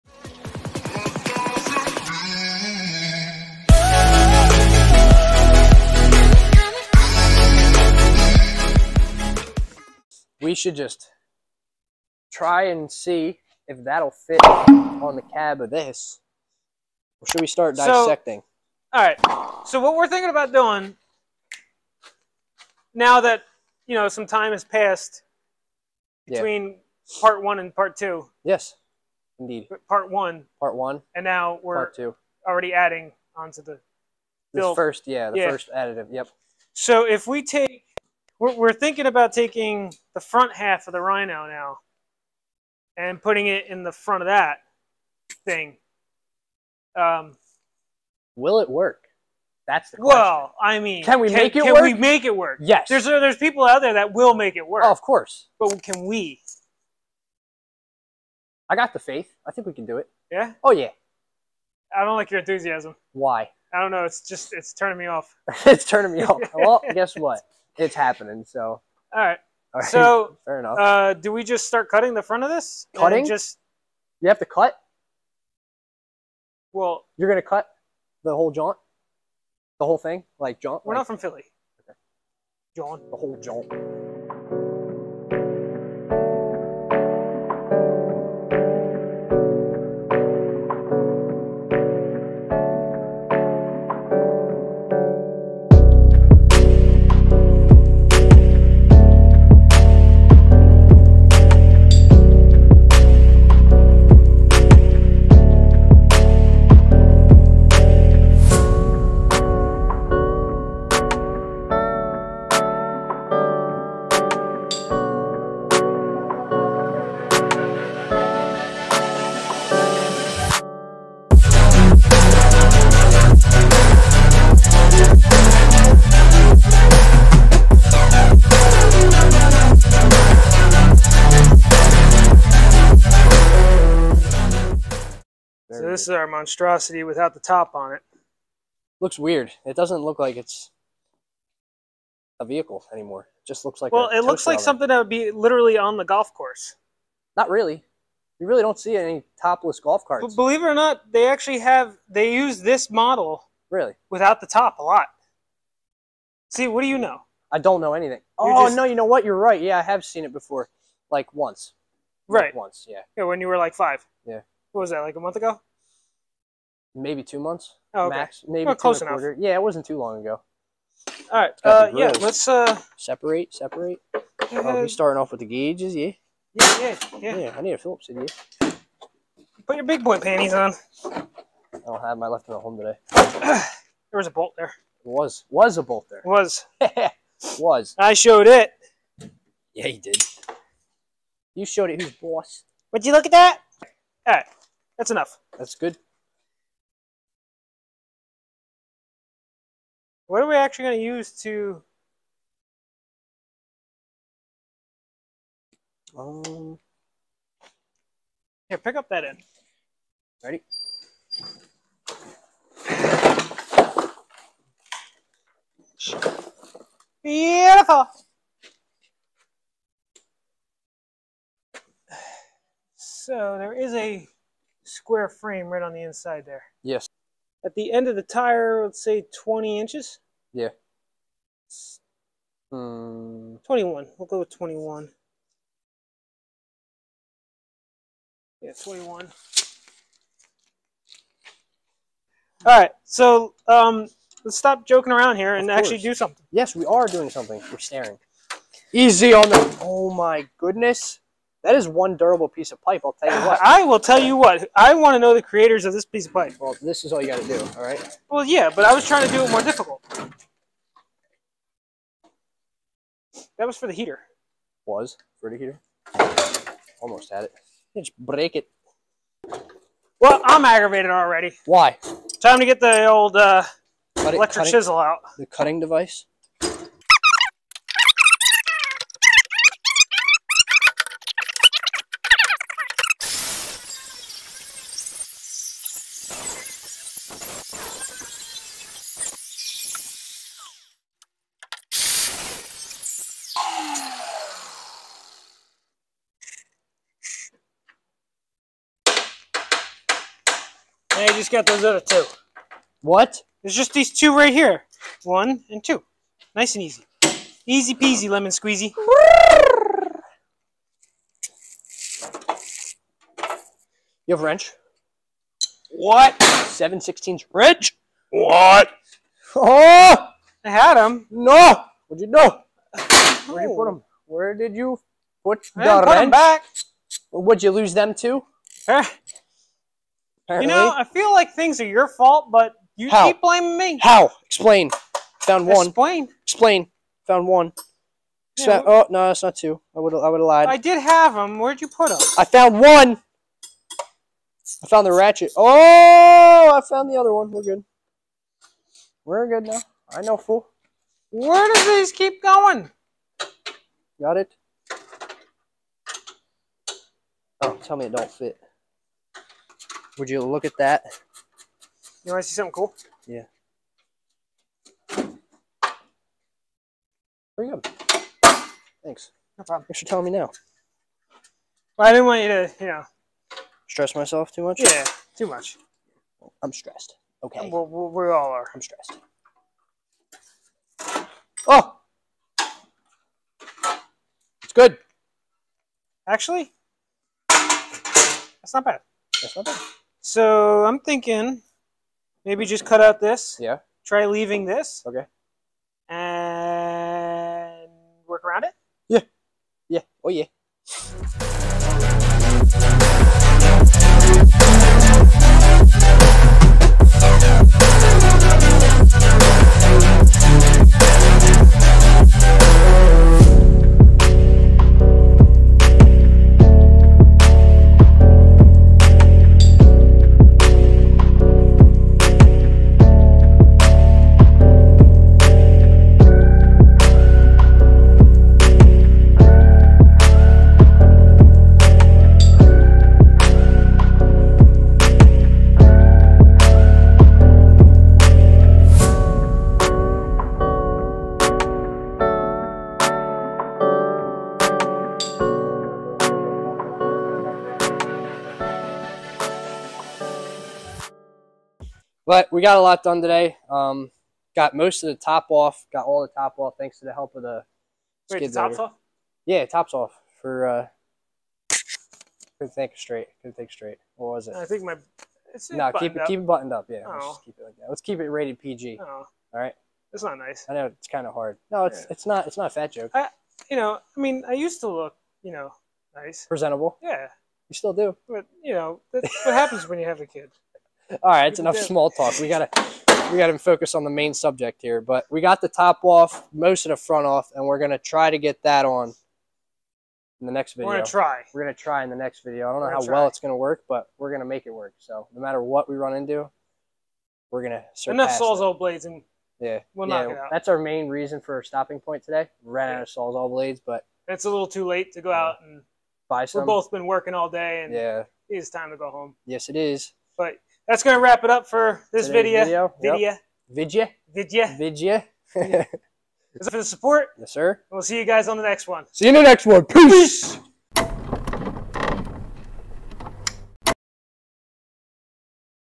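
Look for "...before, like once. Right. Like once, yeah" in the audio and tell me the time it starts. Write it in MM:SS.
02:40.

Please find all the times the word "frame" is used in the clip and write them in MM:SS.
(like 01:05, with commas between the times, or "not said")
03:45.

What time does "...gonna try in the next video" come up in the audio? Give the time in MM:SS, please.
08:11.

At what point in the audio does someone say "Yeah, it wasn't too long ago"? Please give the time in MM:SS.
02:49.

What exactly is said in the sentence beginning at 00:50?
Well, I mean, can we can, make it can work?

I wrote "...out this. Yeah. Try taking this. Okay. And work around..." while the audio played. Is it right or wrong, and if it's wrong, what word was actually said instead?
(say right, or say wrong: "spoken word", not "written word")
wrong: "leaving", not "taking".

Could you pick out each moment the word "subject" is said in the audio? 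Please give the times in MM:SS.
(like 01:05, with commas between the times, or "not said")
08:04.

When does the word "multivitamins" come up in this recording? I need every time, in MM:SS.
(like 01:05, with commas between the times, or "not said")
not said.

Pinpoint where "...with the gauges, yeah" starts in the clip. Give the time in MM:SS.
02:55.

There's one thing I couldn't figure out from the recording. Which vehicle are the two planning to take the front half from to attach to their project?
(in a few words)
Rhino.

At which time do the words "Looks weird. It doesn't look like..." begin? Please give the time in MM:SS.
02:18.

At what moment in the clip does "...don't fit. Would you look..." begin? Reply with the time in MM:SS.
05:58.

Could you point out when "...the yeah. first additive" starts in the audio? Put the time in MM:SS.
00:35.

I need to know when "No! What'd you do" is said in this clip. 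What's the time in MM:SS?
05:21.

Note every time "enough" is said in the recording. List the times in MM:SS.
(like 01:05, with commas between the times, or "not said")
01:10, 02:49, 03:15, 08:01, 08:18.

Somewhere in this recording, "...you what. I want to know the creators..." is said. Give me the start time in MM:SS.
04:14.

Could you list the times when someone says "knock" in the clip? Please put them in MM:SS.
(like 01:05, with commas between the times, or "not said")
08:20.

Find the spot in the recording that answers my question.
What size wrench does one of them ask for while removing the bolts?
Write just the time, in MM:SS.
05:16.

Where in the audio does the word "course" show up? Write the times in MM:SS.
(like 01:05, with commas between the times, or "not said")
00:55, 02:26.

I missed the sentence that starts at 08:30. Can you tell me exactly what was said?
But that's going to wrap it up for this video.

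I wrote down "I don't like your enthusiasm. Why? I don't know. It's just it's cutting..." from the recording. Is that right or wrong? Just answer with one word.
wrong.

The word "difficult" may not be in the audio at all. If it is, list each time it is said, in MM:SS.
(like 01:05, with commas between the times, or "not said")
04:19.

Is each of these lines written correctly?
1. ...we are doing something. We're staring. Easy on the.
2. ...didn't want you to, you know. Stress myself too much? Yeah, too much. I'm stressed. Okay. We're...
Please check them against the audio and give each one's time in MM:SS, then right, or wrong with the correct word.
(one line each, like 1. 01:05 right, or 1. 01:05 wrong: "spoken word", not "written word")
1. 04:06 right
2. 06:12 right.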